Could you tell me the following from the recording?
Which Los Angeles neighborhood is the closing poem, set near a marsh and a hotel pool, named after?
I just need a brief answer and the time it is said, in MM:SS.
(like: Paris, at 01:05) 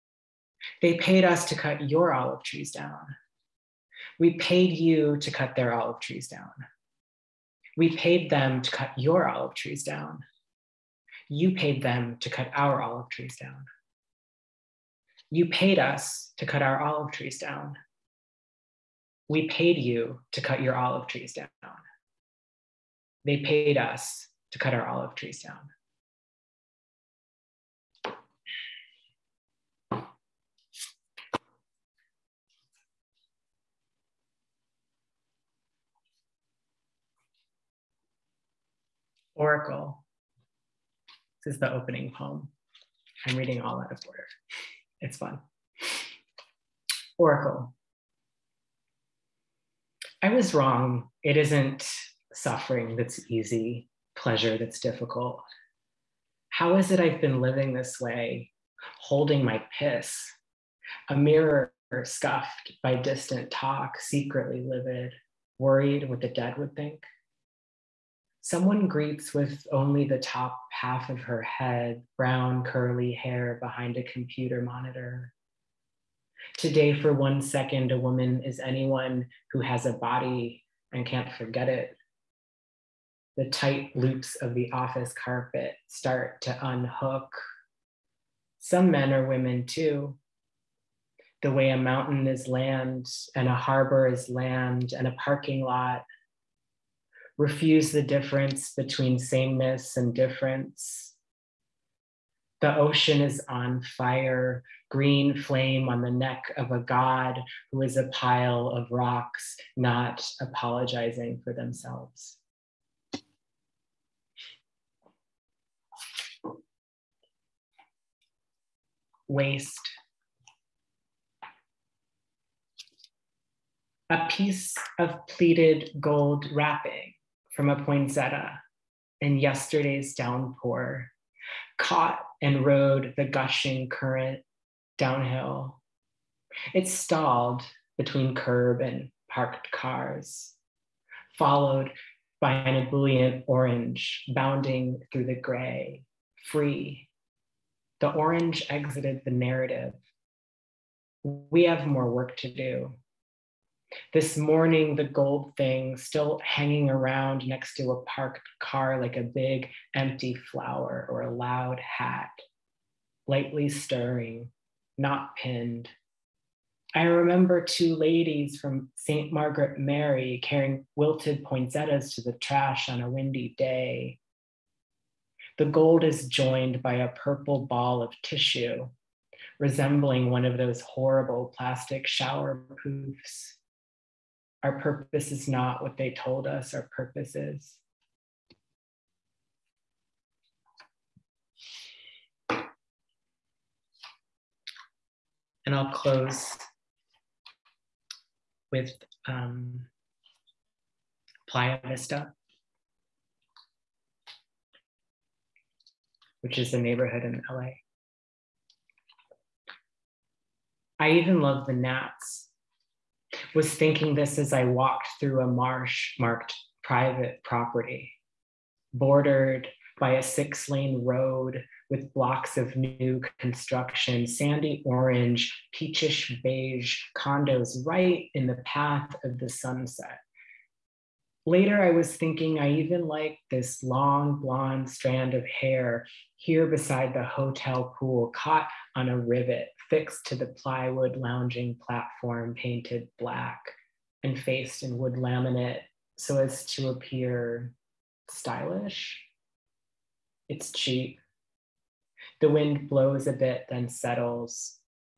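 Playa Vista, at 03:21.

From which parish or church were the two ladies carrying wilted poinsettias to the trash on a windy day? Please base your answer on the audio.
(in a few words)
St. Margaret Mary.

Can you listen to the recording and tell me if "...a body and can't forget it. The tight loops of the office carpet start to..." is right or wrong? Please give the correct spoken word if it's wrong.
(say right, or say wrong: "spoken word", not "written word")
right.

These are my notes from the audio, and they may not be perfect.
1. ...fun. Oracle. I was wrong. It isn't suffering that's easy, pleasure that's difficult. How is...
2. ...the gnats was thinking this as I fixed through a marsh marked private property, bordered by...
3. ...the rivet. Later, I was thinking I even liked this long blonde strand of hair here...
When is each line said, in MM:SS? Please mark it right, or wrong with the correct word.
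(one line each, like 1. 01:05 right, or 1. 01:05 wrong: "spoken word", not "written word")
1. 00:45 right
2. 03:31 wrong: "walked", not "fixed"
3. 03:49 wrong: "sunset", not "rivet".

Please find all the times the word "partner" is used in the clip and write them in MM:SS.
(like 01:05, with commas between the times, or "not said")
not said.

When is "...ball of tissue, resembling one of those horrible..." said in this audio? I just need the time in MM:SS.
02:57.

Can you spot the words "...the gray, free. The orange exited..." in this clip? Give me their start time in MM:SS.
02:25.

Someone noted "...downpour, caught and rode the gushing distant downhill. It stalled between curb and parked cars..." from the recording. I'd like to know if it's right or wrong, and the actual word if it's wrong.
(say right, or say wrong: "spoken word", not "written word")
wrong: "current", not "distant".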